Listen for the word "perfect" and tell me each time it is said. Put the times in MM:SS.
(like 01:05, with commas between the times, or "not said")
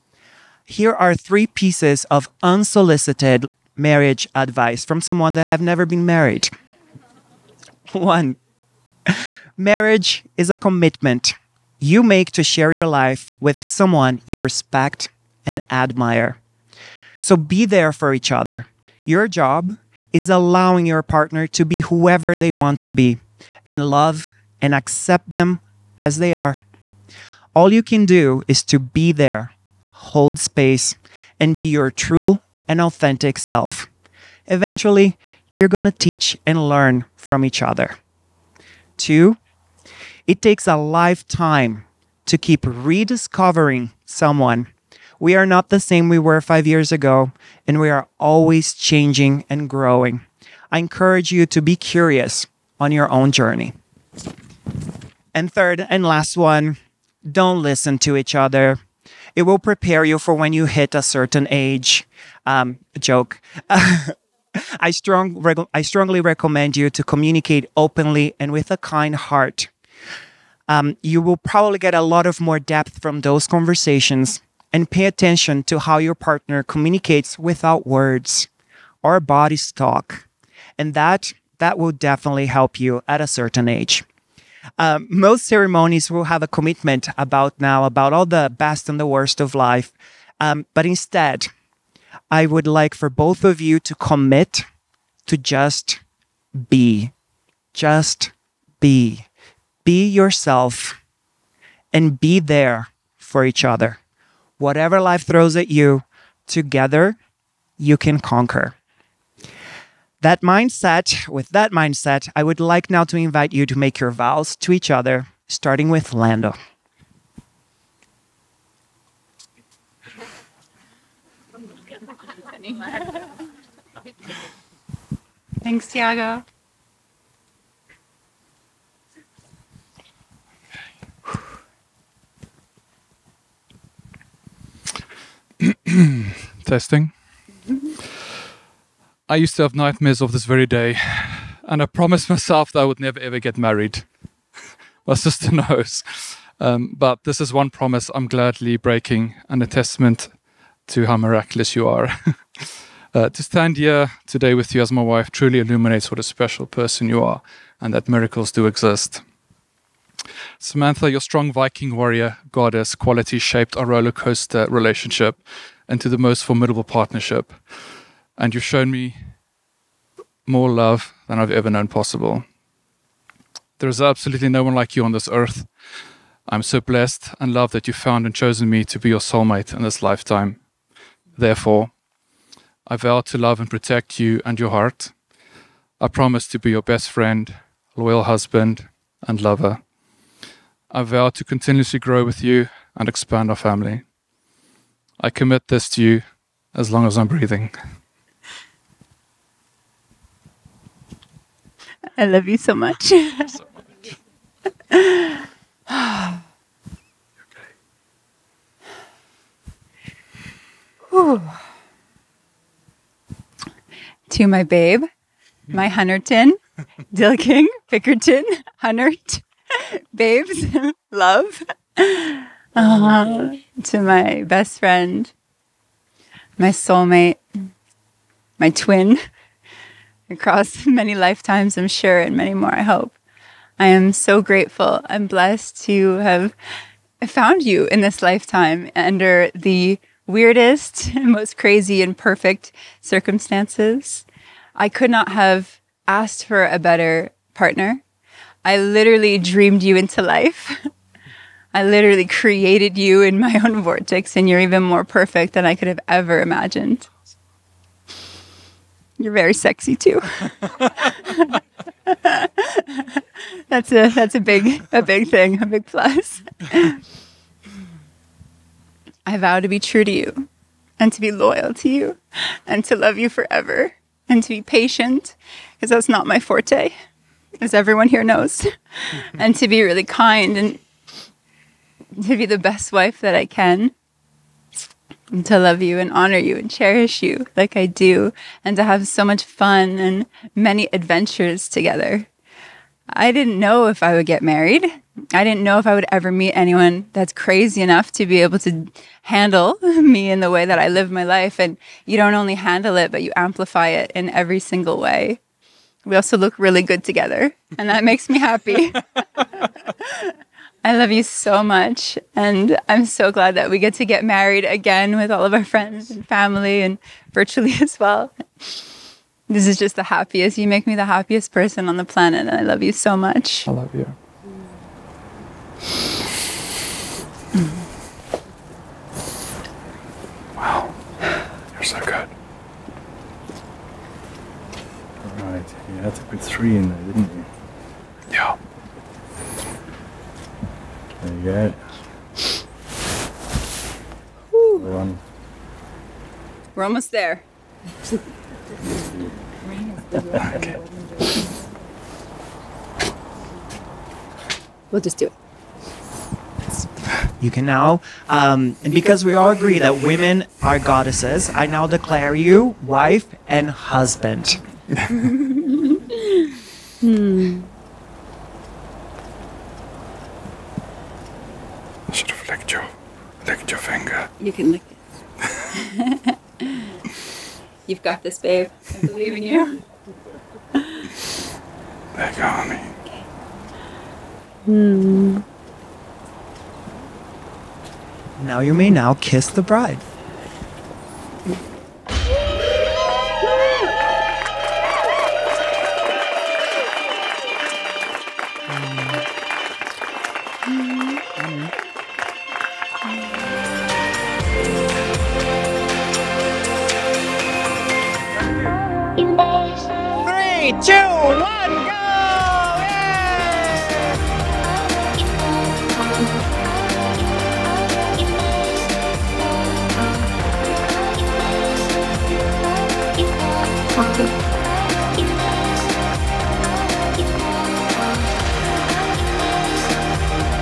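04:02, 04:15.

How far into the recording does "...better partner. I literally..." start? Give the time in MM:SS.
04:06.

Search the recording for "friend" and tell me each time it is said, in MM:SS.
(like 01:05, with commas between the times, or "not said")
03:07, 03:44, 05:15.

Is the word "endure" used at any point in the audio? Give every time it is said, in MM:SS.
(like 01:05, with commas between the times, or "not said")
not said.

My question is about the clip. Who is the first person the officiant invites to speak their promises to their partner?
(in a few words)
Lando.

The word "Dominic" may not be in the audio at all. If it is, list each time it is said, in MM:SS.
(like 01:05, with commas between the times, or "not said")
not said.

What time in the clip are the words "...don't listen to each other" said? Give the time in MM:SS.
00:57.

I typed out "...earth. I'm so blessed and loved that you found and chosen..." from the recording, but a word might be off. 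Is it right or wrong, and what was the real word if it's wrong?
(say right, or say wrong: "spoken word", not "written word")
right.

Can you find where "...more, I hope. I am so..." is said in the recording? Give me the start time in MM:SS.
03:52.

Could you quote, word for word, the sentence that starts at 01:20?
And that that will definitely help you at a certain age.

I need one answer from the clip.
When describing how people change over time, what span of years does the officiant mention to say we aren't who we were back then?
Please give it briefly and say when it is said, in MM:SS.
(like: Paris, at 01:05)
5 years, at 00:46.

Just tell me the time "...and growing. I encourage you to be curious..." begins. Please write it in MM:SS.
00:49.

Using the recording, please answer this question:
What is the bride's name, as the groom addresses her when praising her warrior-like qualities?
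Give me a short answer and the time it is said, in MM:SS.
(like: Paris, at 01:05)
Samantha, at 02:40.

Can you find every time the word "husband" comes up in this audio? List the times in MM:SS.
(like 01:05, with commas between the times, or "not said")
03:08, 06:03.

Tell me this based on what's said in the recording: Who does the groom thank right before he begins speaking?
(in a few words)
Thiago.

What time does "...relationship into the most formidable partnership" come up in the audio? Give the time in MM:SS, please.
02:44.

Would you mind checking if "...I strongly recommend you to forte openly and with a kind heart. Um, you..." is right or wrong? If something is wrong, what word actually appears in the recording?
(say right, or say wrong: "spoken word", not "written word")
wrong: "communicate", not "forte".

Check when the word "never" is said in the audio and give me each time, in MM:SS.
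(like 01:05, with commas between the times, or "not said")
00:05, 02:23.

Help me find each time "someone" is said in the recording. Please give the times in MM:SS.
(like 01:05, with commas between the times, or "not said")
00:05, 00:13, 00:44.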